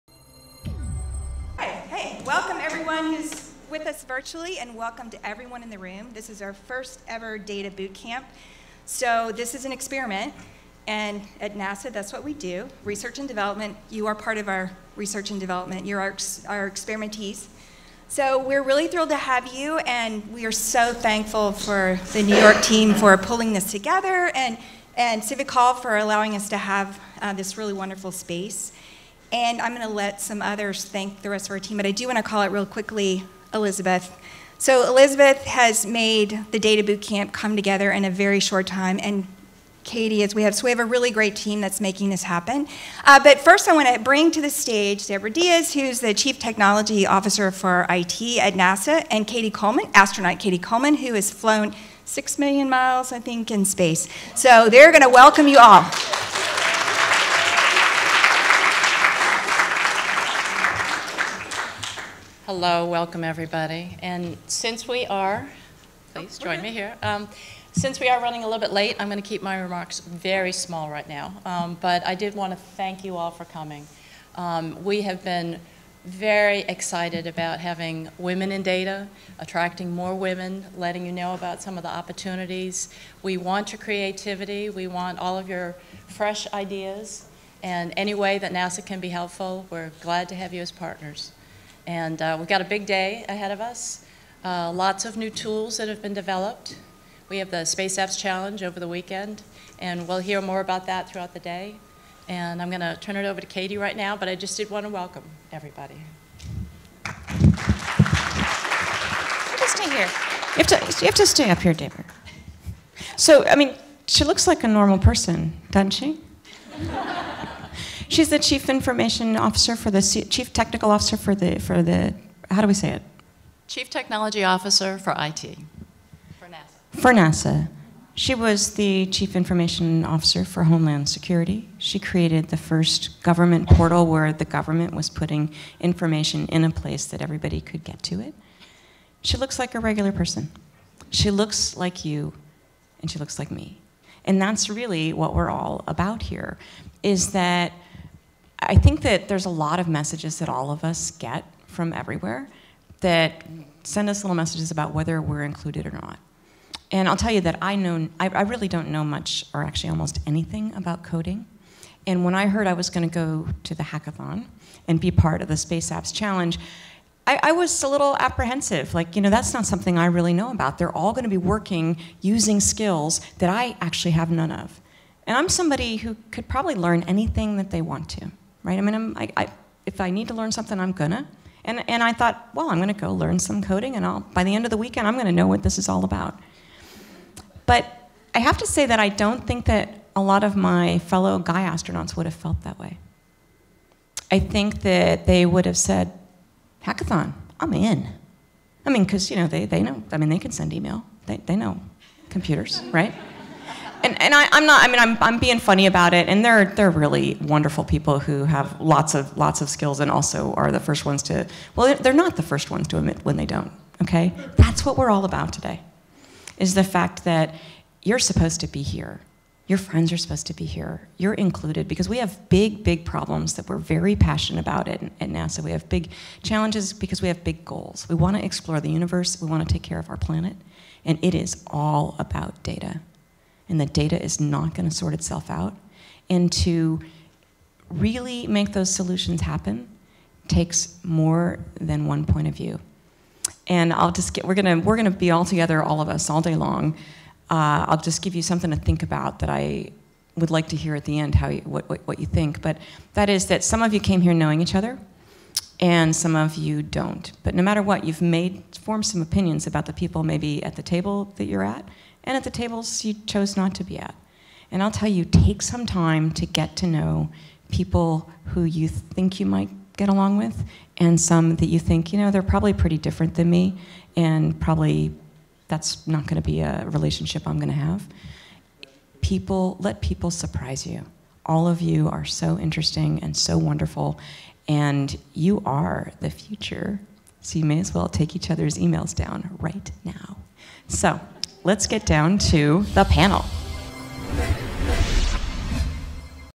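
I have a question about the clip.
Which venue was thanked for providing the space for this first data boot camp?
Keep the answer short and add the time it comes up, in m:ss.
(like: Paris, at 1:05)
Civic Hall, at 0:25.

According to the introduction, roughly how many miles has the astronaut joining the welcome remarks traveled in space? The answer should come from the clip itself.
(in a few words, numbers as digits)
6 million.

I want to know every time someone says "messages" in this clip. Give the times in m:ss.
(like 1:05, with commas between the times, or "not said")
2:29, 2:34.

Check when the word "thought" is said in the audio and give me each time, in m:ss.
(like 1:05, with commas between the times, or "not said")
3:02.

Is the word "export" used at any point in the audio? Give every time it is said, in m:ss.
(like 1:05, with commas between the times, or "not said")
not said.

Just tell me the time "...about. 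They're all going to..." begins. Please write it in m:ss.
2:50.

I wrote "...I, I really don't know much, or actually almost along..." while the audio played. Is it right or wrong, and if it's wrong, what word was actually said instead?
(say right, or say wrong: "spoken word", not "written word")
wrong: "anything", not "along".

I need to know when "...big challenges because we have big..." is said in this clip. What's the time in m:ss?
3:45.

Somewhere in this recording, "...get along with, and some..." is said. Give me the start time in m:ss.
4:29.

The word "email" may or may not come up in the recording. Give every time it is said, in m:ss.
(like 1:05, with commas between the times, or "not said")
3:20, 4:48.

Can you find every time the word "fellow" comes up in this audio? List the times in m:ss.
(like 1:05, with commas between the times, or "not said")
3:10.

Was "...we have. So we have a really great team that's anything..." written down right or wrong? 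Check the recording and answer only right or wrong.
wrong.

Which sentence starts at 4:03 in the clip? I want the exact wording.
And I'll just get, we're gonna, we're gonna be all together, all of us, all day long.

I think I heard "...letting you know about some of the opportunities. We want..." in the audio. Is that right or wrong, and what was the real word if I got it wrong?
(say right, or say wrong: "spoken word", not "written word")
right.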